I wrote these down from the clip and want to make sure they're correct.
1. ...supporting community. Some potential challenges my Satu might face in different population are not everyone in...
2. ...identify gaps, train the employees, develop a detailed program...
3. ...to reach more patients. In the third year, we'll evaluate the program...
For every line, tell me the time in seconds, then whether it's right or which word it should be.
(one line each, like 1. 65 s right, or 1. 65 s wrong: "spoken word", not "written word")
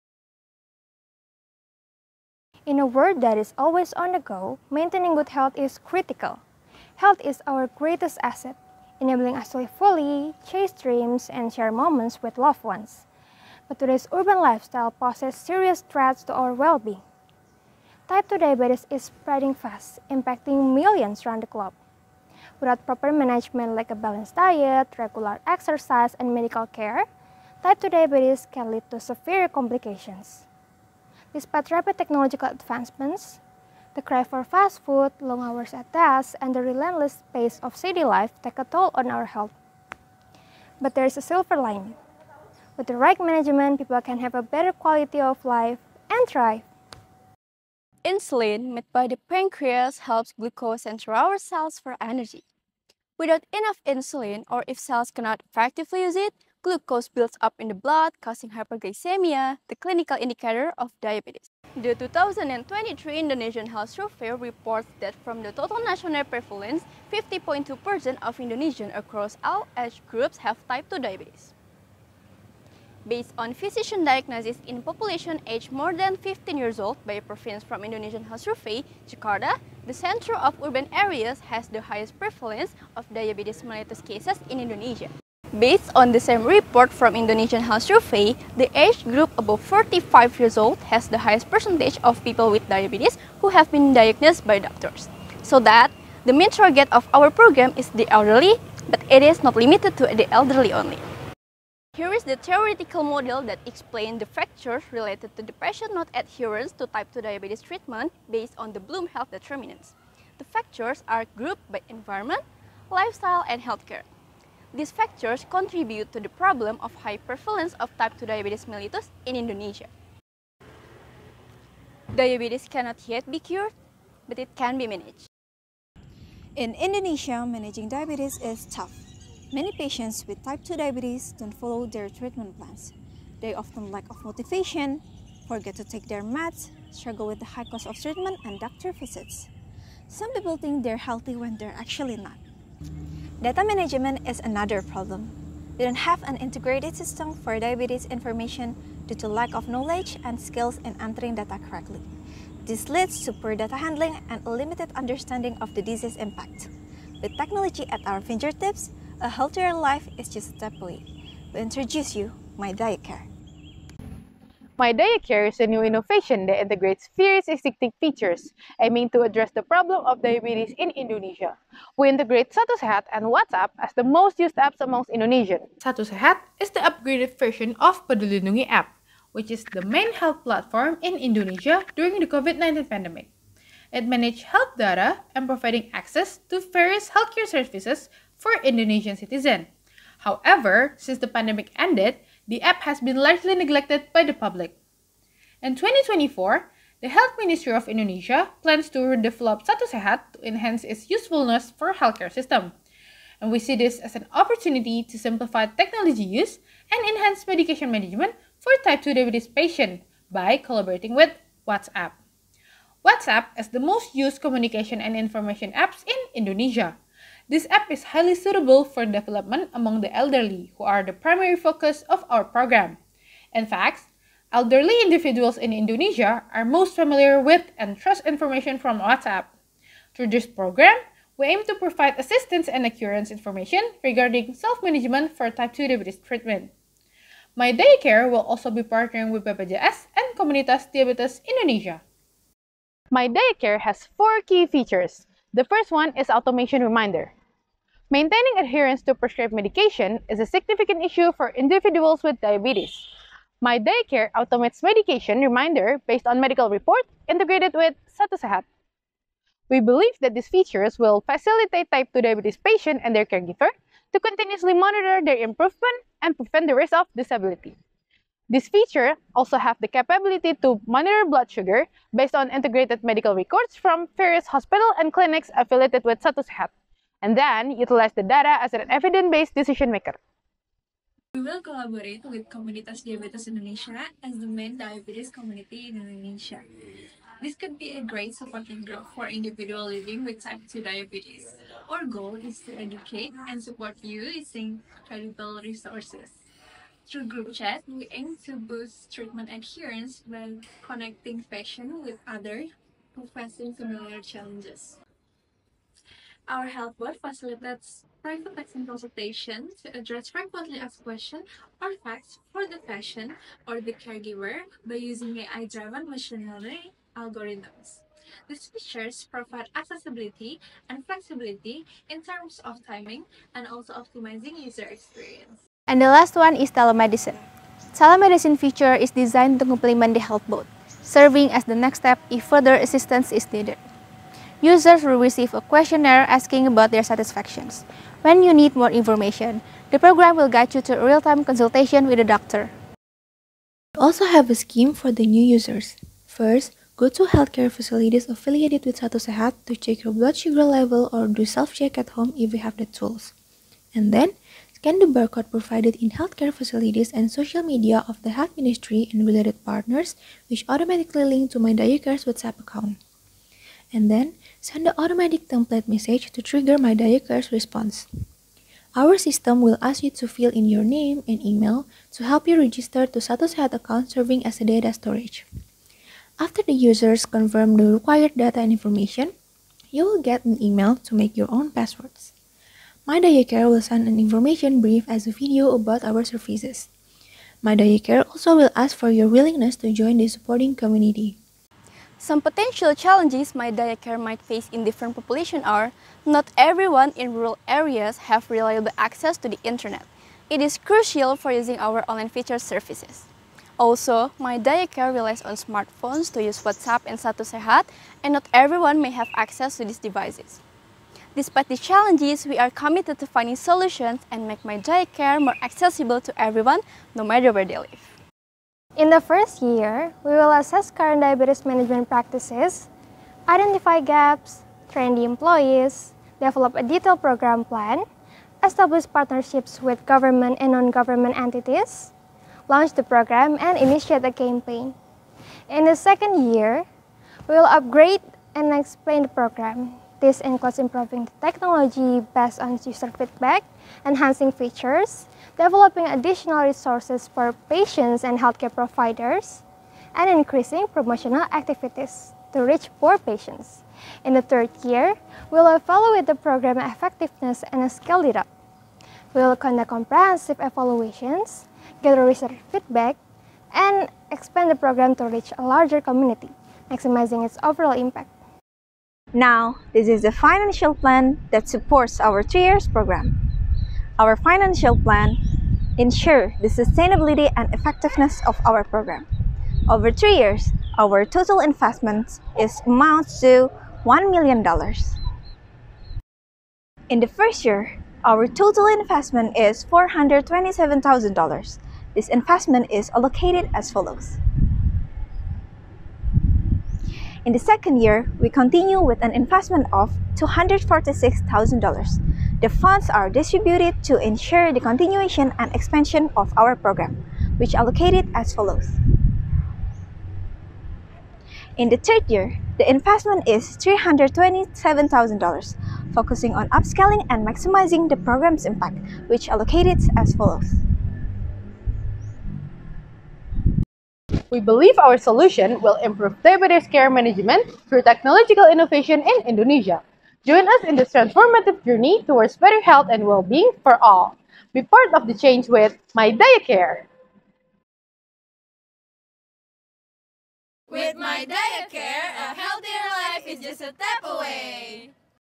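1. 390 s wrong: "DiaCare", not "Satu"
2. 423 s right
3. 452 s right.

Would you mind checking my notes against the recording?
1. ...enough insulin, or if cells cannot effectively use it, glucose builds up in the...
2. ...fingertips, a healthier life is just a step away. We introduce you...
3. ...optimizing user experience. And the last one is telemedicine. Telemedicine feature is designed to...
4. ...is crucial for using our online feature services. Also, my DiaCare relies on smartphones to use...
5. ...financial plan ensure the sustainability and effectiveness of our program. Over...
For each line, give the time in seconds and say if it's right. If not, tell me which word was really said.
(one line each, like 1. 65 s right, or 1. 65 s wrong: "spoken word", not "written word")
1. 53 s right
2. 158 s right
3. 323 s right
4. 400 s right
5. 474 s right.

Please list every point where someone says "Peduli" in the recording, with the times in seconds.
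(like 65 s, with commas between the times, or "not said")
178 s.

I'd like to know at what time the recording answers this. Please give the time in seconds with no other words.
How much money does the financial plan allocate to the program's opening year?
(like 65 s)
489 s.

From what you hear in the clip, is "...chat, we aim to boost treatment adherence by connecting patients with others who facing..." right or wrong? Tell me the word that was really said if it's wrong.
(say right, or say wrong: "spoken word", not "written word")
right.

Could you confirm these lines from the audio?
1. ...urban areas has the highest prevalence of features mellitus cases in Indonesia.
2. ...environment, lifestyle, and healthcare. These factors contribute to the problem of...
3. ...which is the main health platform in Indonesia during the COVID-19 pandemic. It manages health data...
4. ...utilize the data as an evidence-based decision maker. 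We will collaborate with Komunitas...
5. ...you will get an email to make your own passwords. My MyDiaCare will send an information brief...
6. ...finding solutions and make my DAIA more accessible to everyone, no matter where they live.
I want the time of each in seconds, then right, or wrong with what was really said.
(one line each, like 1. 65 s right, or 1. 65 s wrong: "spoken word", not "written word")
1. 80 s wrong: "diabetes", not "features"
2. 111 s right
3. 179 s right
4. 277 s right
5. 379 s right
6. 413 s wrong: "DiaCare", not "DAIA".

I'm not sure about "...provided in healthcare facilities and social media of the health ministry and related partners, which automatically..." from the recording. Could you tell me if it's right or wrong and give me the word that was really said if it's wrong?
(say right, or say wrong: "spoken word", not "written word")
right.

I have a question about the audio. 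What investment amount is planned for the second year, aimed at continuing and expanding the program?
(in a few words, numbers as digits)
$246,000.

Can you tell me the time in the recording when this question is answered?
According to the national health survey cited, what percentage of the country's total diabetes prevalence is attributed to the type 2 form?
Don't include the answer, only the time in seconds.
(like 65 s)
67 s.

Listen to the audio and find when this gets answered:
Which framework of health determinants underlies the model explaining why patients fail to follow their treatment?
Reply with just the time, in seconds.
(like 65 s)
108 s.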